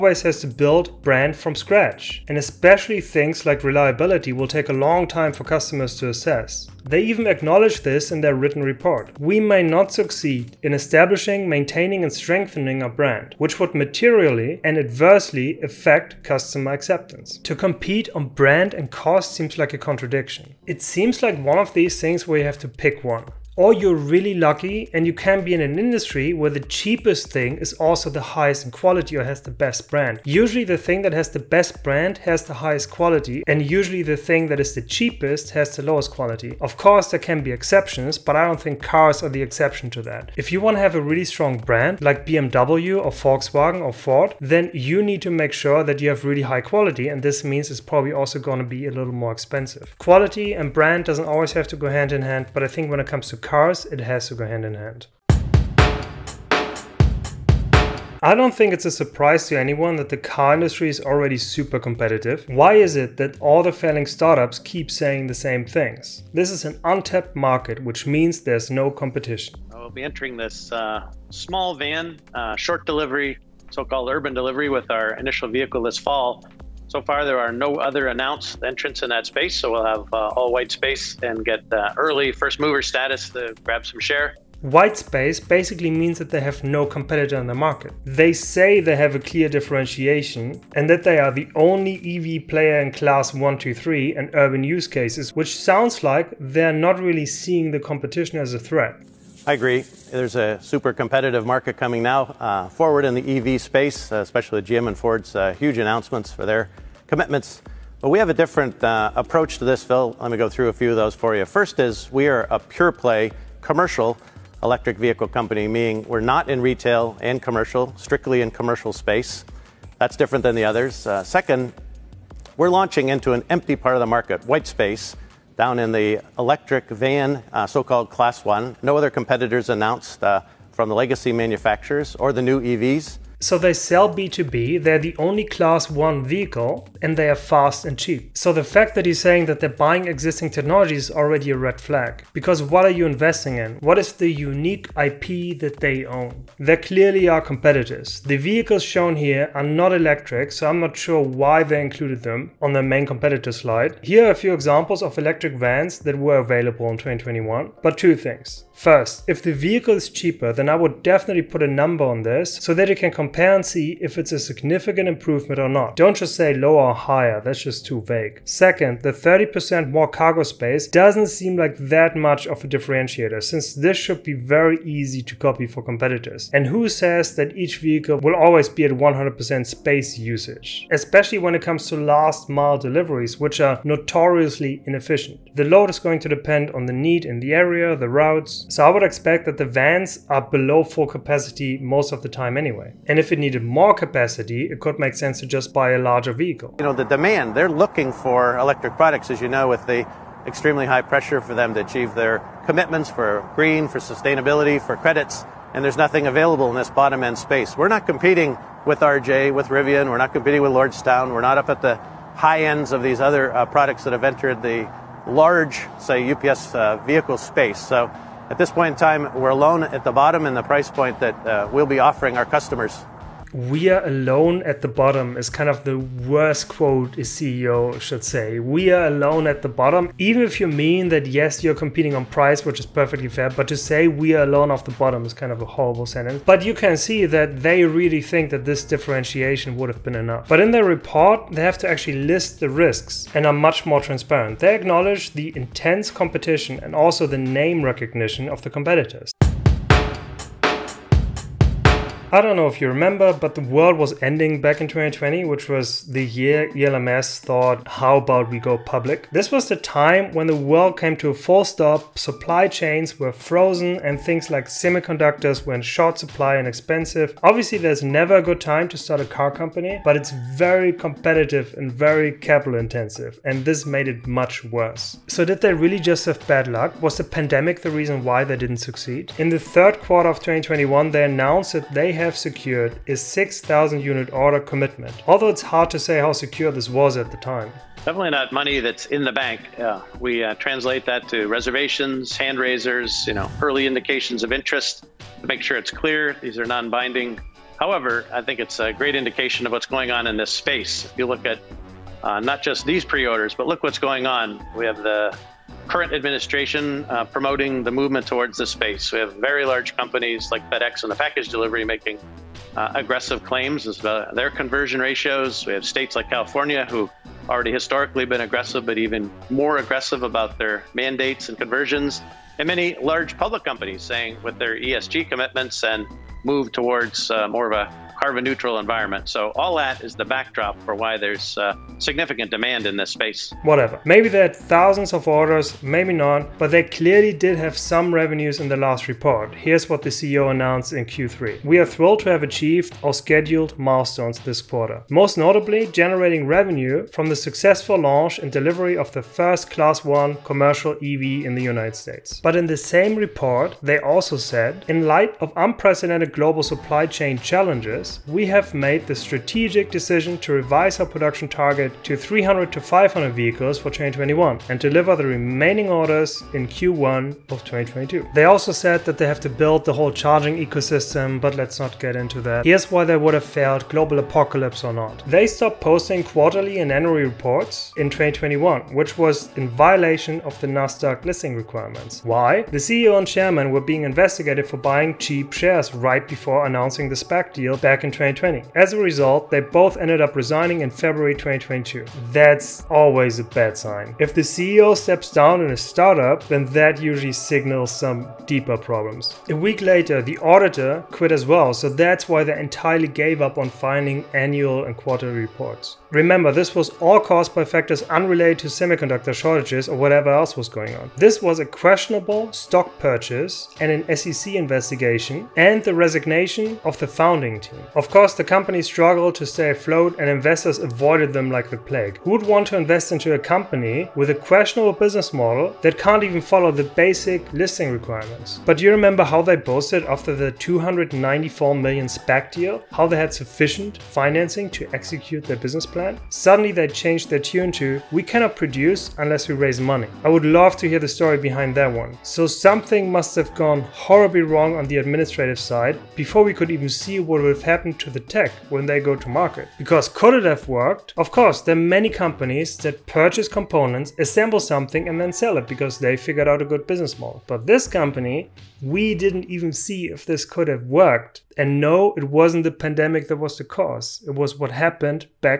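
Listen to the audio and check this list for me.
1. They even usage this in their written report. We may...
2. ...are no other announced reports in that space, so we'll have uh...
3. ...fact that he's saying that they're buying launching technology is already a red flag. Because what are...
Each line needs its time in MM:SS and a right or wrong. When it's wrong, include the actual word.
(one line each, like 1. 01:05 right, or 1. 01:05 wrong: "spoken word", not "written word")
1. 00:06 wrong: "acknowledge", not "usage"
2. 01:17 wrong: "entrants", not "reports"
3. 02:18 wrong: "existing", not "launching".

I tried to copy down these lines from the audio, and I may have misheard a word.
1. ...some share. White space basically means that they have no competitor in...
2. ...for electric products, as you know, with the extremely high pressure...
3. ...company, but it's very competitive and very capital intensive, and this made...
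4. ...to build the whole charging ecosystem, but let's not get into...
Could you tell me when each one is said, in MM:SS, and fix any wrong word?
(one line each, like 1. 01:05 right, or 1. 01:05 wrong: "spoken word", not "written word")
1. 01:23 right
2. 03:18 right
3. 04:29 right
4. 06:09 right.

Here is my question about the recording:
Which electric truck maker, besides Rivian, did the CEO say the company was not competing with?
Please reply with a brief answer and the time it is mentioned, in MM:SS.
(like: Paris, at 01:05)
Lordstown, at 03:30.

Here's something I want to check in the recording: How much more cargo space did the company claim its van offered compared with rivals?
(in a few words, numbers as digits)
30%.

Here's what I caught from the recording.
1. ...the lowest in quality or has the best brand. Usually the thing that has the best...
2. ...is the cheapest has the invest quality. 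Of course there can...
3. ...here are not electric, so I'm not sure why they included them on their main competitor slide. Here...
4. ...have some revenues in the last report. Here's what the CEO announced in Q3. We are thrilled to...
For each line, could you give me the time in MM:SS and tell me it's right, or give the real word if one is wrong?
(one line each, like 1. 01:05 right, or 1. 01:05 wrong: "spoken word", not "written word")
1. 00:28 wrong: "highest", not "lowest"
2. 00:34 wrong: "lowest", not "invest"
3. 02:29 right
4. 05:37 right.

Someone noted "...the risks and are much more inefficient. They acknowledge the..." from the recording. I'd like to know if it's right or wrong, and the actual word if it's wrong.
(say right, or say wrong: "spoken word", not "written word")
wrong: "transparent", not "inefficient".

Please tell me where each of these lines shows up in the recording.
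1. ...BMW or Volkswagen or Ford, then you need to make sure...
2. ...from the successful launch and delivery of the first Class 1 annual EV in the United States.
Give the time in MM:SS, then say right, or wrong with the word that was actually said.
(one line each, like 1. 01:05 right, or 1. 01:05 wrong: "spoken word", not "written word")
1. 00:42 right
2. 05:47 wrong: "commercial", not "annual".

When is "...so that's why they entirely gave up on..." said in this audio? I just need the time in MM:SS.
06:41.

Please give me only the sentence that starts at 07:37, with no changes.
But this company, we didn't even see if this could have worked.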